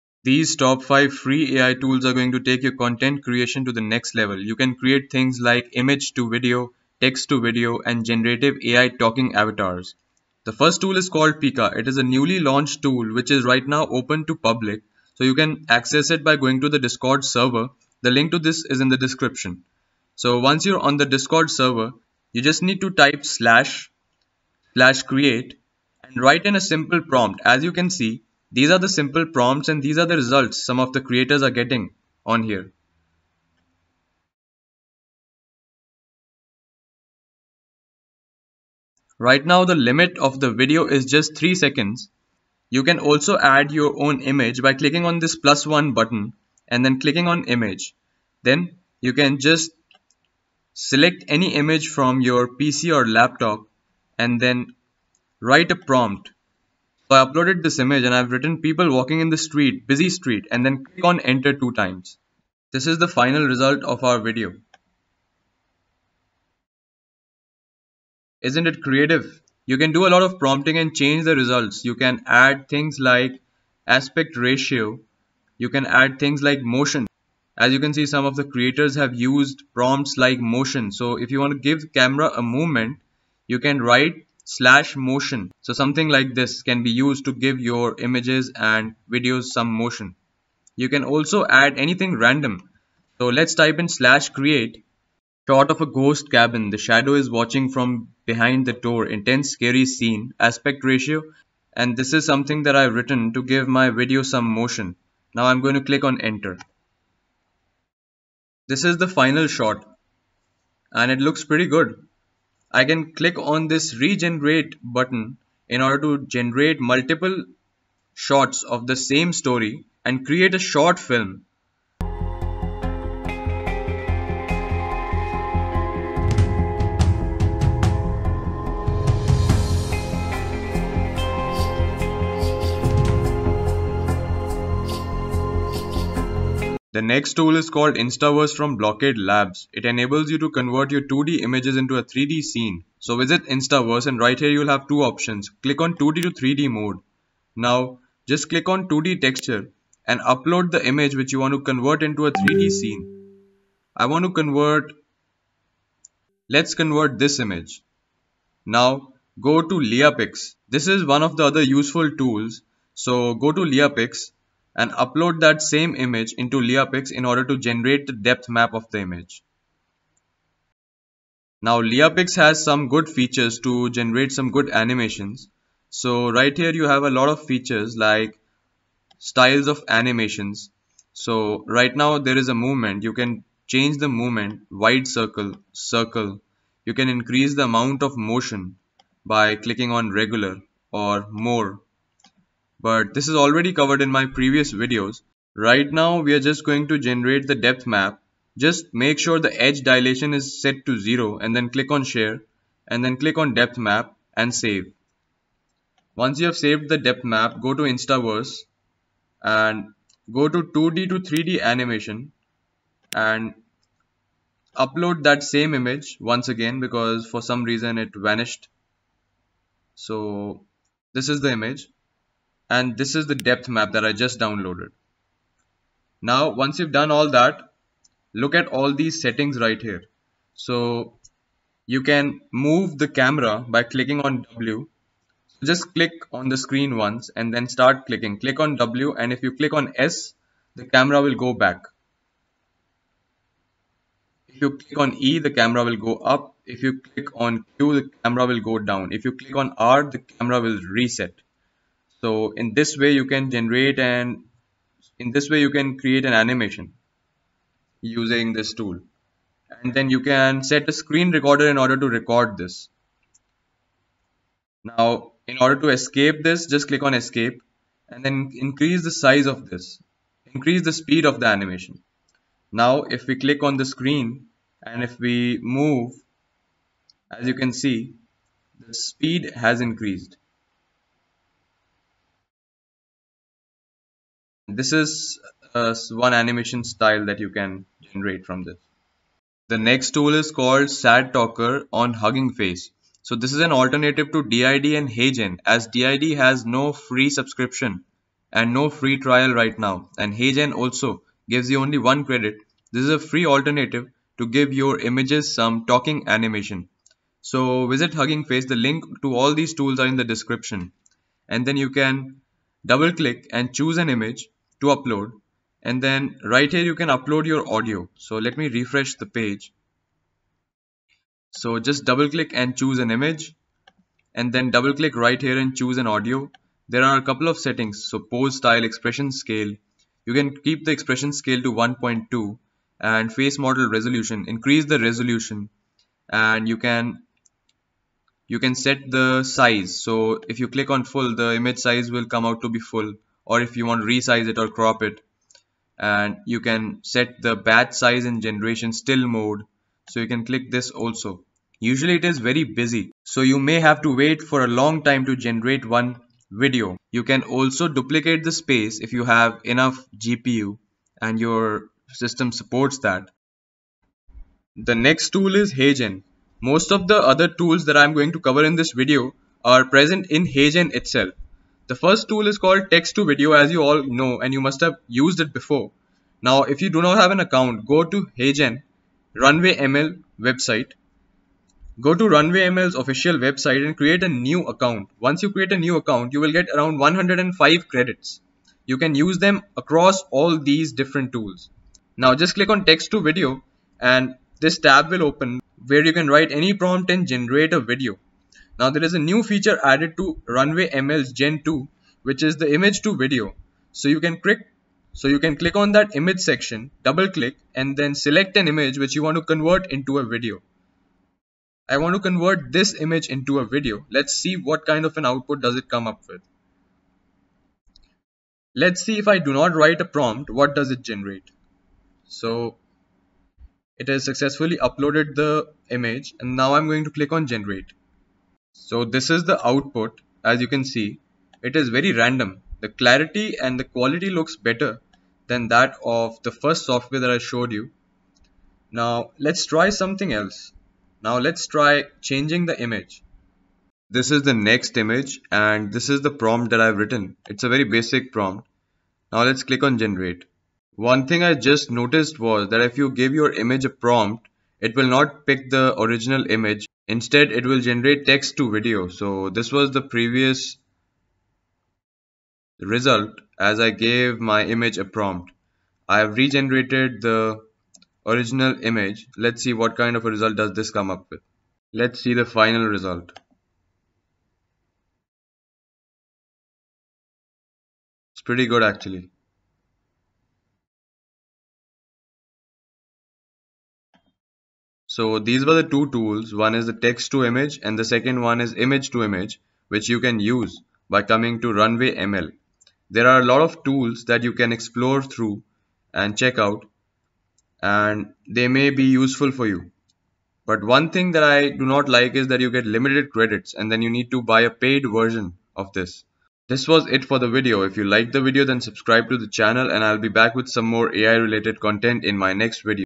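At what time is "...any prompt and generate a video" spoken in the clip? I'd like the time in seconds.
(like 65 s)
396 s.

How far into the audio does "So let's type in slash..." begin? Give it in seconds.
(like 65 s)
93 s.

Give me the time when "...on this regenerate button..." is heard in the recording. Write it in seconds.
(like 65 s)
113 s.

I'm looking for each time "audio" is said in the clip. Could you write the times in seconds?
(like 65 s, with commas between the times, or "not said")
317 s, 326 s.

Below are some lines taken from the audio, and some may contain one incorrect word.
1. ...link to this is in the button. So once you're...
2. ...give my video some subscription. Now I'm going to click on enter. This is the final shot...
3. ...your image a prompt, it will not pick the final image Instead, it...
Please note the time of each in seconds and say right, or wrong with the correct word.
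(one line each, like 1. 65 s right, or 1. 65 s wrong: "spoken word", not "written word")
1. 18 s wrong: "description", not "button"
2. 103 s wrong: "motion", not "subscription"
3. 453 s wrong: "original", not "final".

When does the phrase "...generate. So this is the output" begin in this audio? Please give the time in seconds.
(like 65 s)
427 s.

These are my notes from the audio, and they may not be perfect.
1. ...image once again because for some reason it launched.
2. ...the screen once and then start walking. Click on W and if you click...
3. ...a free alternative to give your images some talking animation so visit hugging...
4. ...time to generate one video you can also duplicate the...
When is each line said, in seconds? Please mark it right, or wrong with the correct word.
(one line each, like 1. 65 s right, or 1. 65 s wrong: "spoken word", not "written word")
1. 215 s wrong: "vanished", not "launched"
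2. 236 s wrong: "clicking", not "walking"
3. 303 s right
4. 355 s right.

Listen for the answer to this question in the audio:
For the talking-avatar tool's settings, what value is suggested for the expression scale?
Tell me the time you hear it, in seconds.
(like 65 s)
331 s.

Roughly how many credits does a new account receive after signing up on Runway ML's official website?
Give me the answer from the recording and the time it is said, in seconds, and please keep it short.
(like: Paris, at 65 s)
105, at 386 s.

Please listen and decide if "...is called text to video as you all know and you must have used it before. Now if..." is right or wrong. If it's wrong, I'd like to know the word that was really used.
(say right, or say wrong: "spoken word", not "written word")
right.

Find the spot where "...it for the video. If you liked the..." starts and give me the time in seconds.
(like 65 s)
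507 s.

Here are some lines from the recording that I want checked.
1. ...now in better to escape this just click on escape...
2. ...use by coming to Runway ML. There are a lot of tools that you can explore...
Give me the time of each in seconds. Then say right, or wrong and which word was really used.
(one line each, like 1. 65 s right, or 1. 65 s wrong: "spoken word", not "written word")
1. 264 s wrong: "order", not "better"
2. 490 s right.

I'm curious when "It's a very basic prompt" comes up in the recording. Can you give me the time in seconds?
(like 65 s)
447 s.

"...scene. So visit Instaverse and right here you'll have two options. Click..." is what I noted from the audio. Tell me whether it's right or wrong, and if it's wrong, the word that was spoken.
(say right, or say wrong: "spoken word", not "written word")
right.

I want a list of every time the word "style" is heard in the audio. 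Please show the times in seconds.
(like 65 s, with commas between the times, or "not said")
179 s, 286 s, 328 s.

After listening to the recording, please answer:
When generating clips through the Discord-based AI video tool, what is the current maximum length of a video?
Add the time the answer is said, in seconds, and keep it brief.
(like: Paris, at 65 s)
3 seconds, at 41 s.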